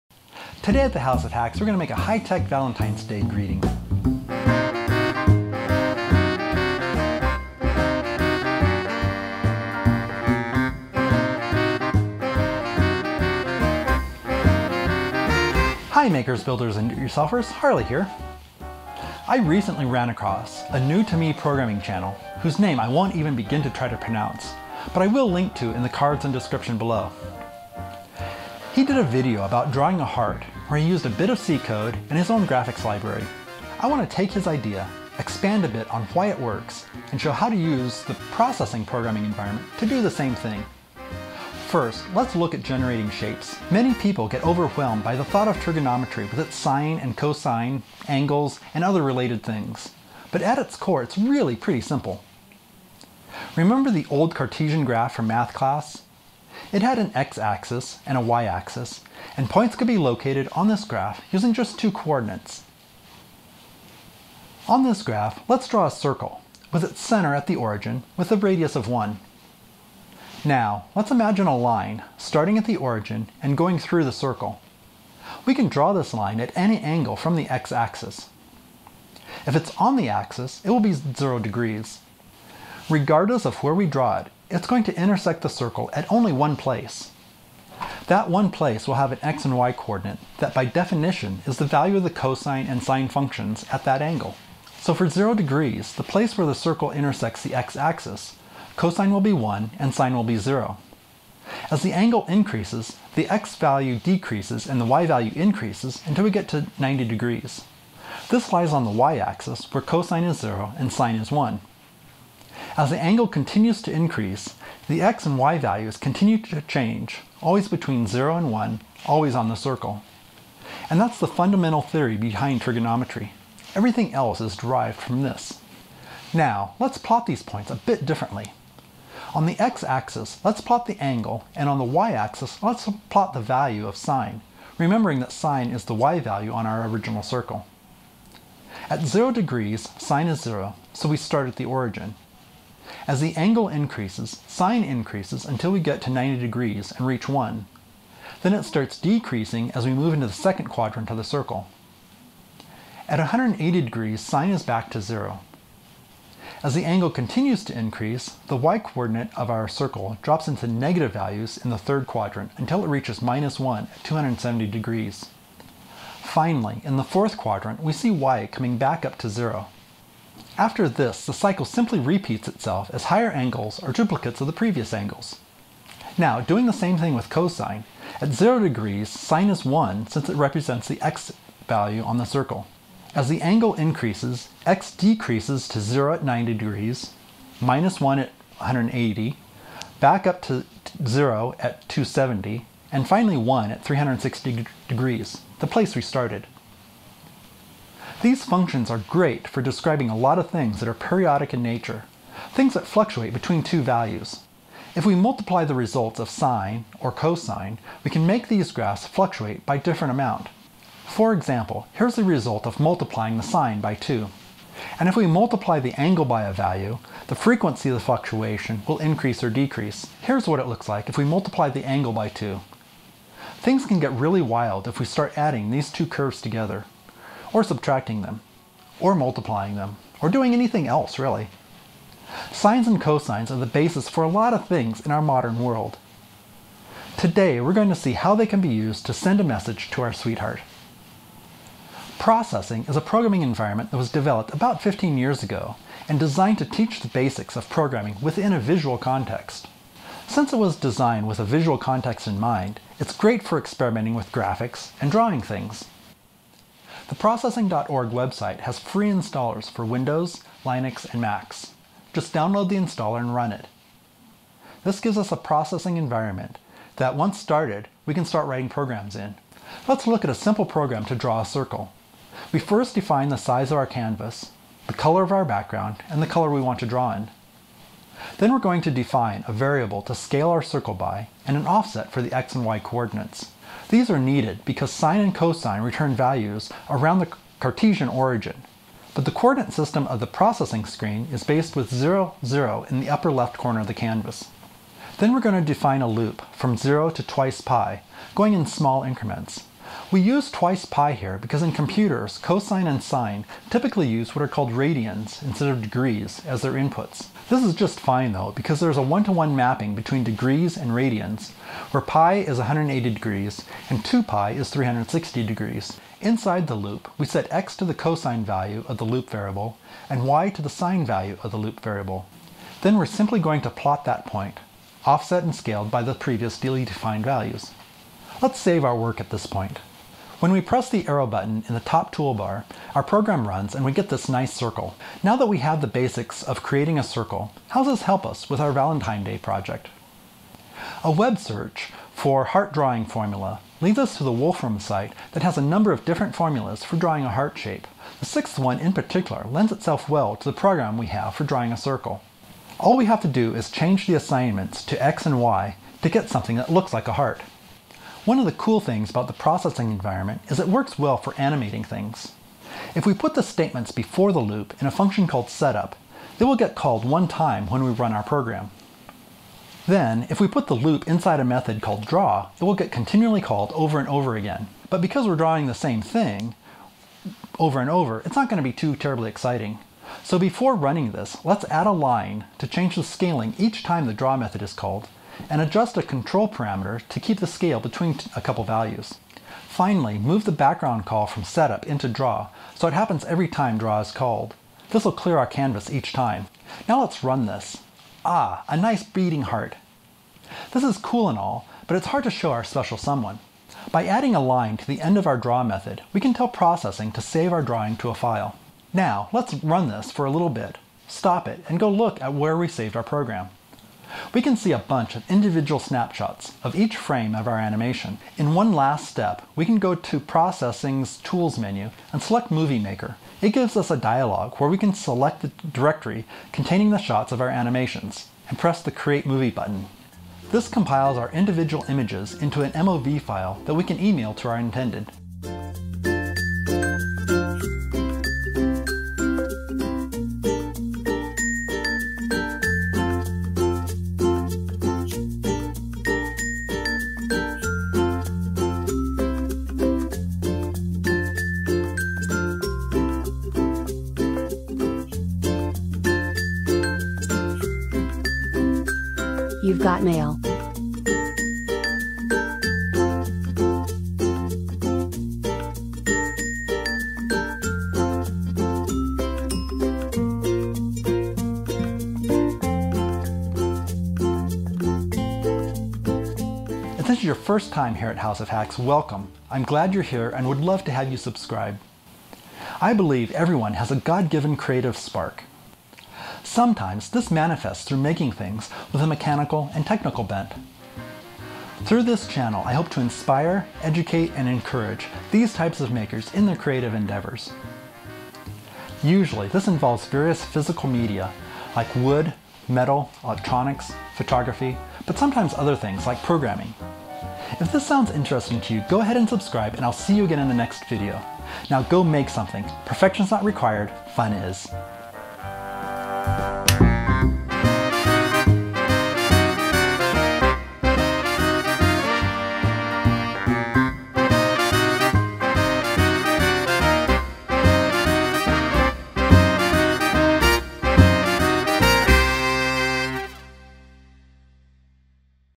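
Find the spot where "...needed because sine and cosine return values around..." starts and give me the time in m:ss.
4:44.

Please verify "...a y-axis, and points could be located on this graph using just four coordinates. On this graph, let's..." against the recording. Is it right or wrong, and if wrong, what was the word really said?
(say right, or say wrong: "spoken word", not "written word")
wrong: "two", not "four".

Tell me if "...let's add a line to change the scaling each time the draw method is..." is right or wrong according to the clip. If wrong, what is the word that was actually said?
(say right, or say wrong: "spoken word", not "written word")
right.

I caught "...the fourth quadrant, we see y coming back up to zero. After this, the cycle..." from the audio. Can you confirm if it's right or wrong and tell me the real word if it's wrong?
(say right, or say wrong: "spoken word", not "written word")
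right.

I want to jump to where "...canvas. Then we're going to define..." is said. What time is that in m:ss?
4:53.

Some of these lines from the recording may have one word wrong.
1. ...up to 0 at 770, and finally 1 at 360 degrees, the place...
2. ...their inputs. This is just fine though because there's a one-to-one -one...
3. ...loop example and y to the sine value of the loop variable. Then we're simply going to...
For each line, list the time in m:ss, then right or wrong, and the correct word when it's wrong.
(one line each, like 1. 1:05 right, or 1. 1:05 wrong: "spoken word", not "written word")
1. 3:10 wrong: "270", not "770"
2. 5:06 right
3. 5:19 wrong: "variable", not "example".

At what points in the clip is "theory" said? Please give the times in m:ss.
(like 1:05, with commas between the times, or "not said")
2:01.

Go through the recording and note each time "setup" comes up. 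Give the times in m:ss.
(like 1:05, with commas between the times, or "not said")
6:05, 6:31.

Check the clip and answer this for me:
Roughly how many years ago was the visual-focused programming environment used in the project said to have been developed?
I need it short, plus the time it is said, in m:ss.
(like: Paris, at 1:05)
15, at 4:04.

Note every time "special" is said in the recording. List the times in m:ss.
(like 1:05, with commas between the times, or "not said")
6:42.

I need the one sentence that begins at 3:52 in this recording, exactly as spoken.
Sines and cosines are the basis for a lot of things in our modern world.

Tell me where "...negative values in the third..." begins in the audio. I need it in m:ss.
2:40.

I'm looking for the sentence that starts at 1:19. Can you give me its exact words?
If it's on the axis, it will be 0 degrees.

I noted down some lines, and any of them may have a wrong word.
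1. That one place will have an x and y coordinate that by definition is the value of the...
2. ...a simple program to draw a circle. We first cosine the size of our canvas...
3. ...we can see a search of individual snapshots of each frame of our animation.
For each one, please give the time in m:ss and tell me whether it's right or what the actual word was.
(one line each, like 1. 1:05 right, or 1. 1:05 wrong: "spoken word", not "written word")
1. 1:28 right
2. 4:30 wrong: "define", not "cosine"
3. 6:54 wrong: "bunch", not "search".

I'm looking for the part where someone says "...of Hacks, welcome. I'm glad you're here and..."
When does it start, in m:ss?
7:58.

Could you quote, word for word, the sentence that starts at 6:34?
This will clear our canvas each time.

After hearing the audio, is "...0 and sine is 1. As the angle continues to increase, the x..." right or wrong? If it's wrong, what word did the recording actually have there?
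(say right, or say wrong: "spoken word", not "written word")
right.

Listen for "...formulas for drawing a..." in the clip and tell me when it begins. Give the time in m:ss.
5:46.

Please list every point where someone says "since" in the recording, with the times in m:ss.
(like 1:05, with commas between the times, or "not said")
3:00, 4:10.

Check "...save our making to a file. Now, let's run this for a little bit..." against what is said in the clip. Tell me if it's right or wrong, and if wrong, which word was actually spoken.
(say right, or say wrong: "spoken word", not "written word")
wrong: "drawing", not "making".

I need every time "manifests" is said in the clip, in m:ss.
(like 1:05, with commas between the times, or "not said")
8:07.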